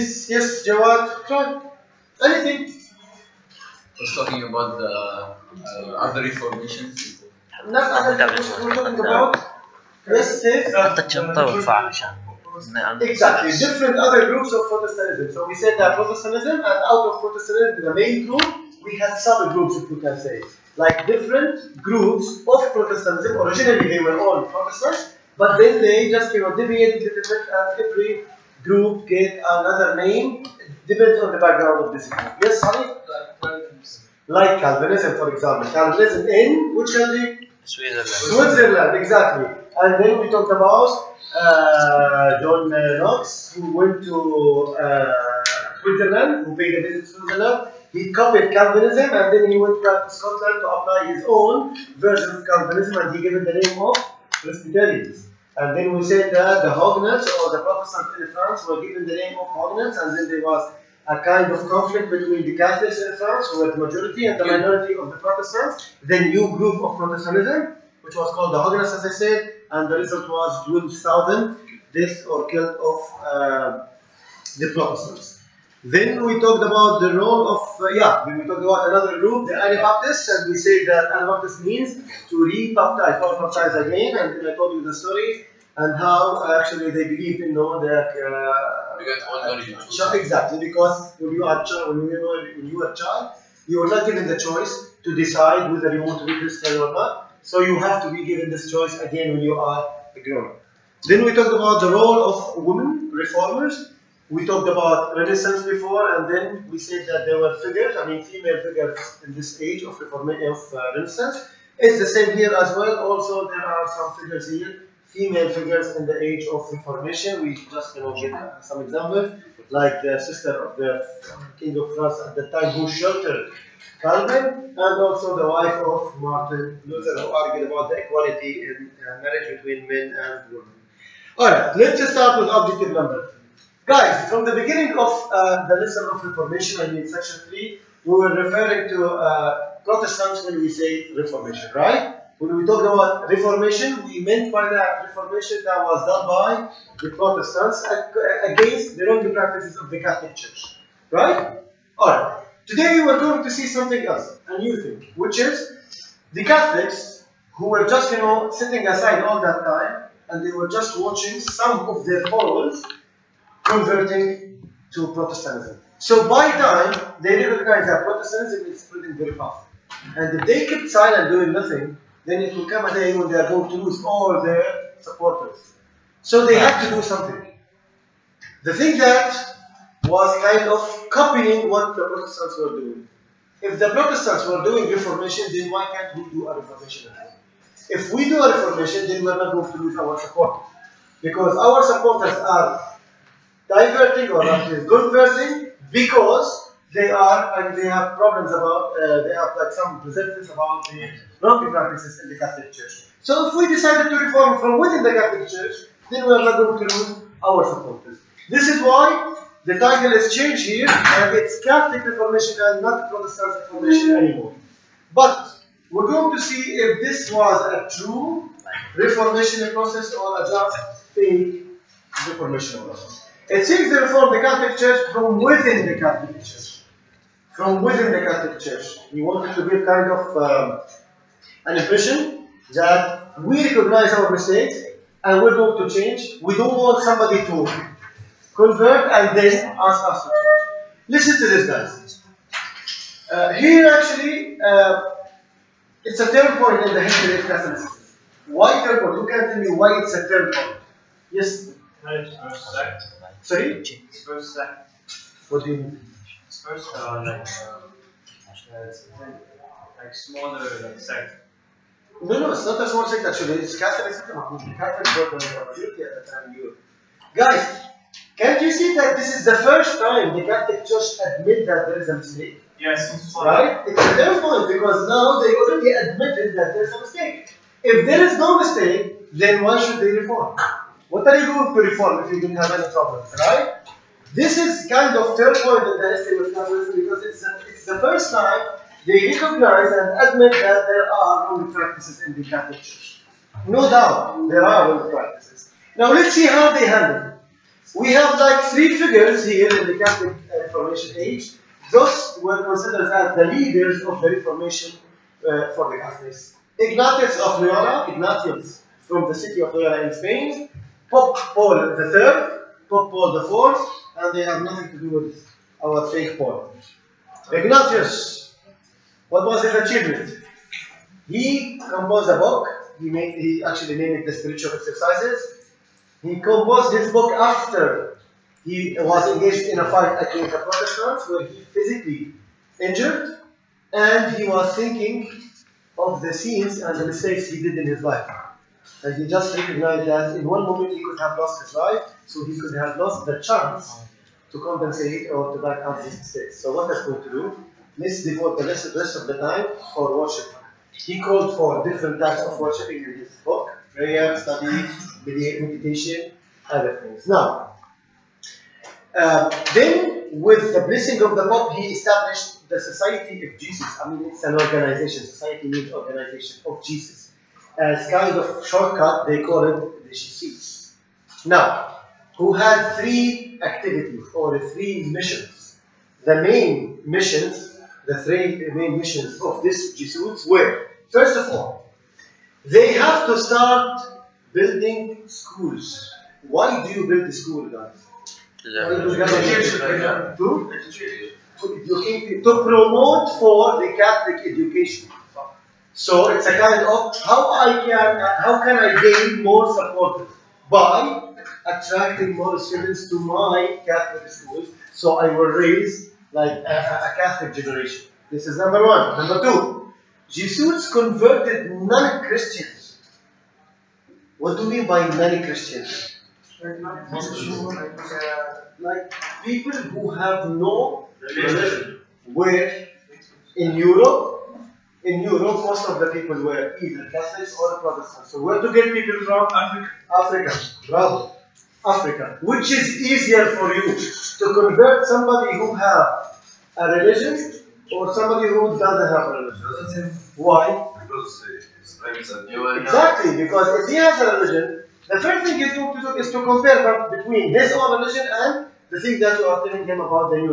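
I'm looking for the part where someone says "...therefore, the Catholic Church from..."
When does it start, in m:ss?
3:43.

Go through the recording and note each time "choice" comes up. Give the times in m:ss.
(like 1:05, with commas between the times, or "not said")
1:34, 1:38.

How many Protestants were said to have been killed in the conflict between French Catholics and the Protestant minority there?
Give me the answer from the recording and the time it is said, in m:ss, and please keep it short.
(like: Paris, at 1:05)
12,000, at 1:10.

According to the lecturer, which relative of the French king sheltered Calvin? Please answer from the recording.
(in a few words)
The sister.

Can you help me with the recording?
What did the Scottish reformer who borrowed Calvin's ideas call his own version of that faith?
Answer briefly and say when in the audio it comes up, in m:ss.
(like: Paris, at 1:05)
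Presbyterians, at 0:54.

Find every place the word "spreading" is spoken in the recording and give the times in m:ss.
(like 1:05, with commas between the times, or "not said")
2:48.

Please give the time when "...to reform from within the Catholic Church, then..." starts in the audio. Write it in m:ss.
3:24.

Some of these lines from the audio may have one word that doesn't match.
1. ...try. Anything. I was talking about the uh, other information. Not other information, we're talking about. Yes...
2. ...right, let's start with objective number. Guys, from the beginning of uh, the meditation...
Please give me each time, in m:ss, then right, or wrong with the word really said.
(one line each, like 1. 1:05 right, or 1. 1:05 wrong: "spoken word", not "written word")
1. 0:01 right
2. 2:11 wrong: "lesson", not "meditation".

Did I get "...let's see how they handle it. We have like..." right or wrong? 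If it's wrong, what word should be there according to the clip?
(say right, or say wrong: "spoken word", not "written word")
right.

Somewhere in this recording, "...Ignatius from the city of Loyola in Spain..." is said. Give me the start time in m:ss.
5:08.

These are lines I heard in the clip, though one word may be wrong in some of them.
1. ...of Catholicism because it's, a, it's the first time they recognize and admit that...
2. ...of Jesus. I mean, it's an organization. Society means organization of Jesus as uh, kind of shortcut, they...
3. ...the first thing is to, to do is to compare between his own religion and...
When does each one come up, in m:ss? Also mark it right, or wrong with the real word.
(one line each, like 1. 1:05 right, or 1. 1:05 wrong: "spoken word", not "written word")
1. 4:46 right
2. 6:03 right
3. 7:25 right.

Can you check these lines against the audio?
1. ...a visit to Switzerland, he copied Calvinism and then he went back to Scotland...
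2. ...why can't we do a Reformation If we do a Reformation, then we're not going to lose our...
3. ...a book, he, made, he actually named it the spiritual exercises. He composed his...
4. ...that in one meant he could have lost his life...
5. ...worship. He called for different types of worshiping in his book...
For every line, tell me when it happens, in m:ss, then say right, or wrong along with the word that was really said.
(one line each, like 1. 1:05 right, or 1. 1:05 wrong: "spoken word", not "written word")
1. 0:46 right
2. 3:05 right
3. 5:22 right
4. 5:40 wrong: "moment", not "meant"
5. 5:50 right.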